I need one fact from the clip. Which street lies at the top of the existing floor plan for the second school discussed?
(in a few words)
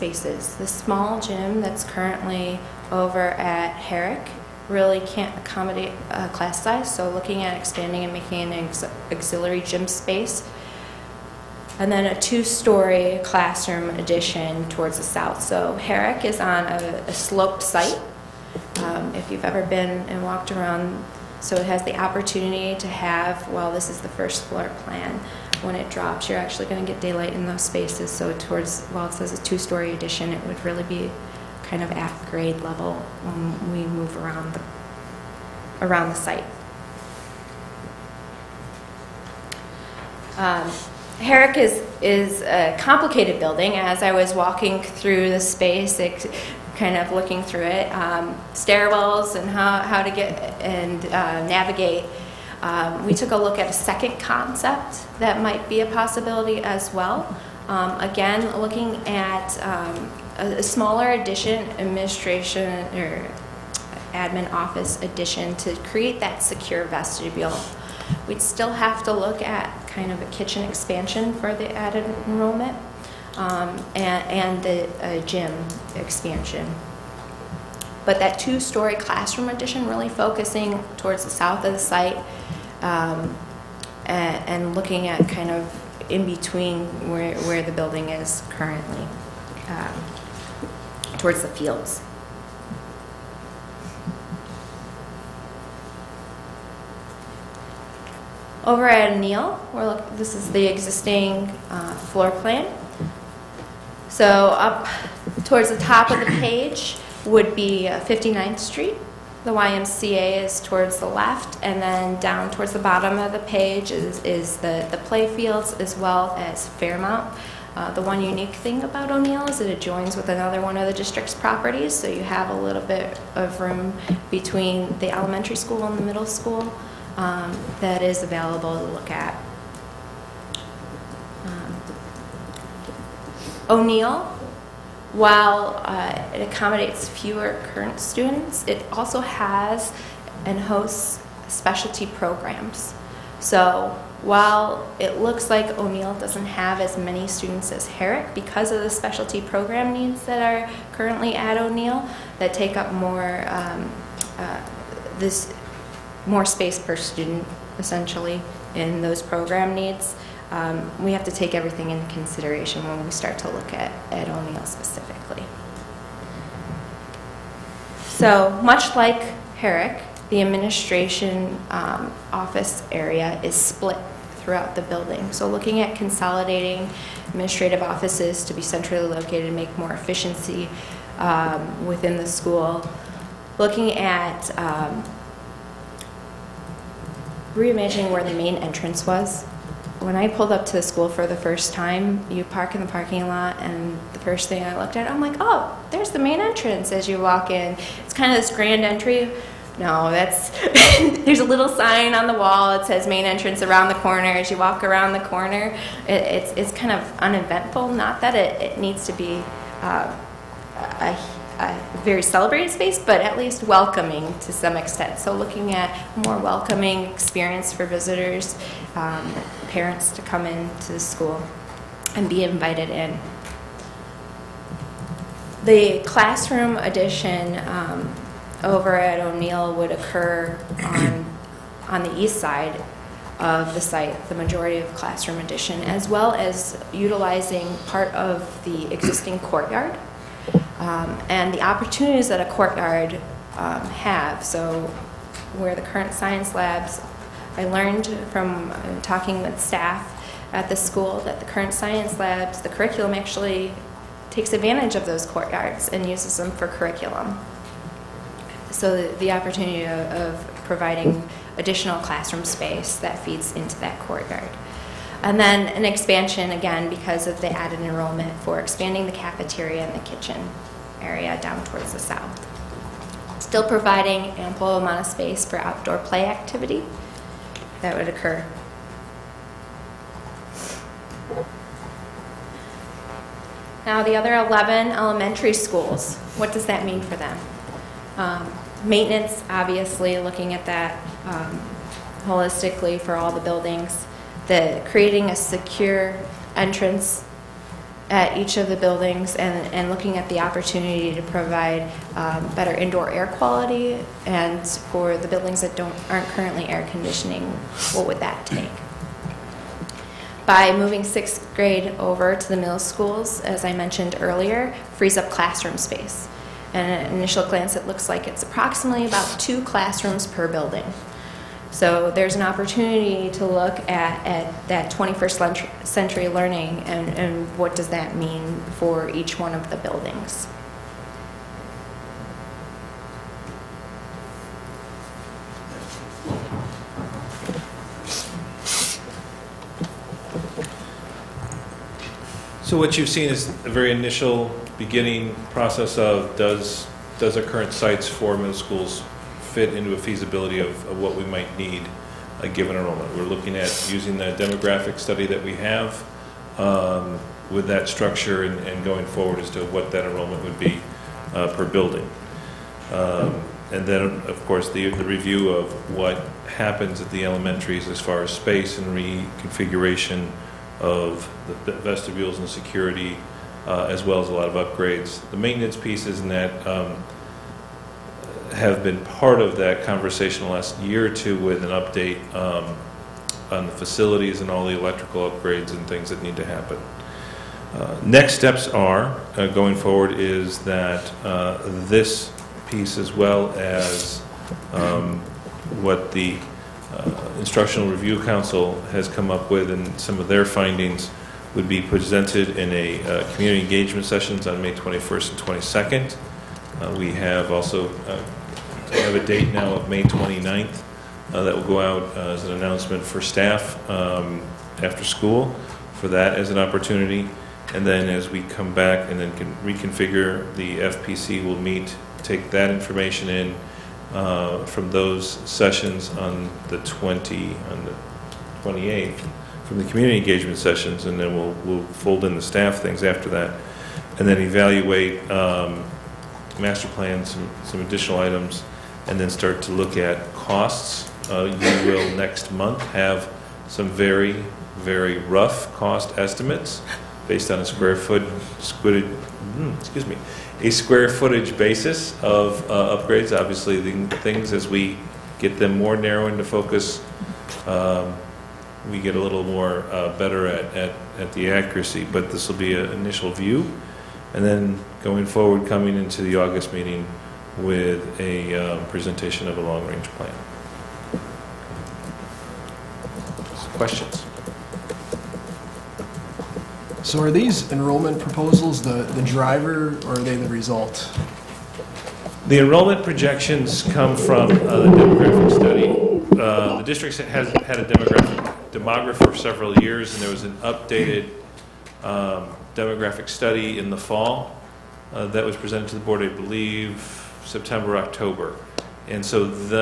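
59th Street.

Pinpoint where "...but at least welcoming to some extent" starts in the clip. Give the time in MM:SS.
03:32.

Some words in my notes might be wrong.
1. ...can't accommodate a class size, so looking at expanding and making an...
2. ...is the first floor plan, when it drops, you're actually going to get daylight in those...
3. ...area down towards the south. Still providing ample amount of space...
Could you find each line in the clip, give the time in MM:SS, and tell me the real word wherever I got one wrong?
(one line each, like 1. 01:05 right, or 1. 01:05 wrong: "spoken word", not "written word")
1. 00:05 right
2. 00:23 right
3. 04:31 right.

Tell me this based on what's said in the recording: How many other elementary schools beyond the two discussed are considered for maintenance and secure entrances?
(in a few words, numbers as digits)
11.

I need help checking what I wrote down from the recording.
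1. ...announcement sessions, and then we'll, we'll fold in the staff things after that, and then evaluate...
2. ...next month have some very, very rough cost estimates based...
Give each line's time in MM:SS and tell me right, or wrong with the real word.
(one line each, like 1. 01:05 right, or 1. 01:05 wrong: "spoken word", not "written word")
1. 07:10 wrong: "engagement", not "announcement"
2. 07:22 right.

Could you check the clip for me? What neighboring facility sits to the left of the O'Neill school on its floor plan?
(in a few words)
YMCA.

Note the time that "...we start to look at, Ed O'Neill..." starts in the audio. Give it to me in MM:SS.
02:43.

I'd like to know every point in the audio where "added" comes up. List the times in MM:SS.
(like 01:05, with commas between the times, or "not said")
01:11, 04:27.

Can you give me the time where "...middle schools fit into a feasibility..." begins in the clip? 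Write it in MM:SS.
05:48.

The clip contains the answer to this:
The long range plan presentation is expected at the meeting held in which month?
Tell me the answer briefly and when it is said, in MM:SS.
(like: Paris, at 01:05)
August, at 07:46.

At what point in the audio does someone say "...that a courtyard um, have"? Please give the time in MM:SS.
04:02.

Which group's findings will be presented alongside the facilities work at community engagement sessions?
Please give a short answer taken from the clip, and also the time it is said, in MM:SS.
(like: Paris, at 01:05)
Instructional Review Council, at 06:37.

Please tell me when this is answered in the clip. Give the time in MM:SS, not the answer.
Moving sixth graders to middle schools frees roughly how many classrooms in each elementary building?
05:19.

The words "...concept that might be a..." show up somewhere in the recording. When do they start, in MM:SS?
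00:54.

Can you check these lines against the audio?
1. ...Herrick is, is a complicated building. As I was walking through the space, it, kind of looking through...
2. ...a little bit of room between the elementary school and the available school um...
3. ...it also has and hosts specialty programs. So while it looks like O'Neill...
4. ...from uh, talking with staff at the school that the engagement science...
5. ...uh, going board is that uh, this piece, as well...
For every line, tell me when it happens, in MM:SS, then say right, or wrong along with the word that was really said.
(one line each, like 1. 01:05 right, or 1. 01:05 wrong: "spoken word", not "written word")
1. 00:41 right
2. 02:02 wrong: "middle", not "available"
3. 02:18 right
4. 04:08 wrong: "current", not "engagement"
5. 06:29 wrong: "forward", not "board".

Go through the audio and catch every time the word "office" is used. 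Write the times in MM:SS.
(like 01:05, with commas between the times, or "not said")
01:04, 02:52, 02:57.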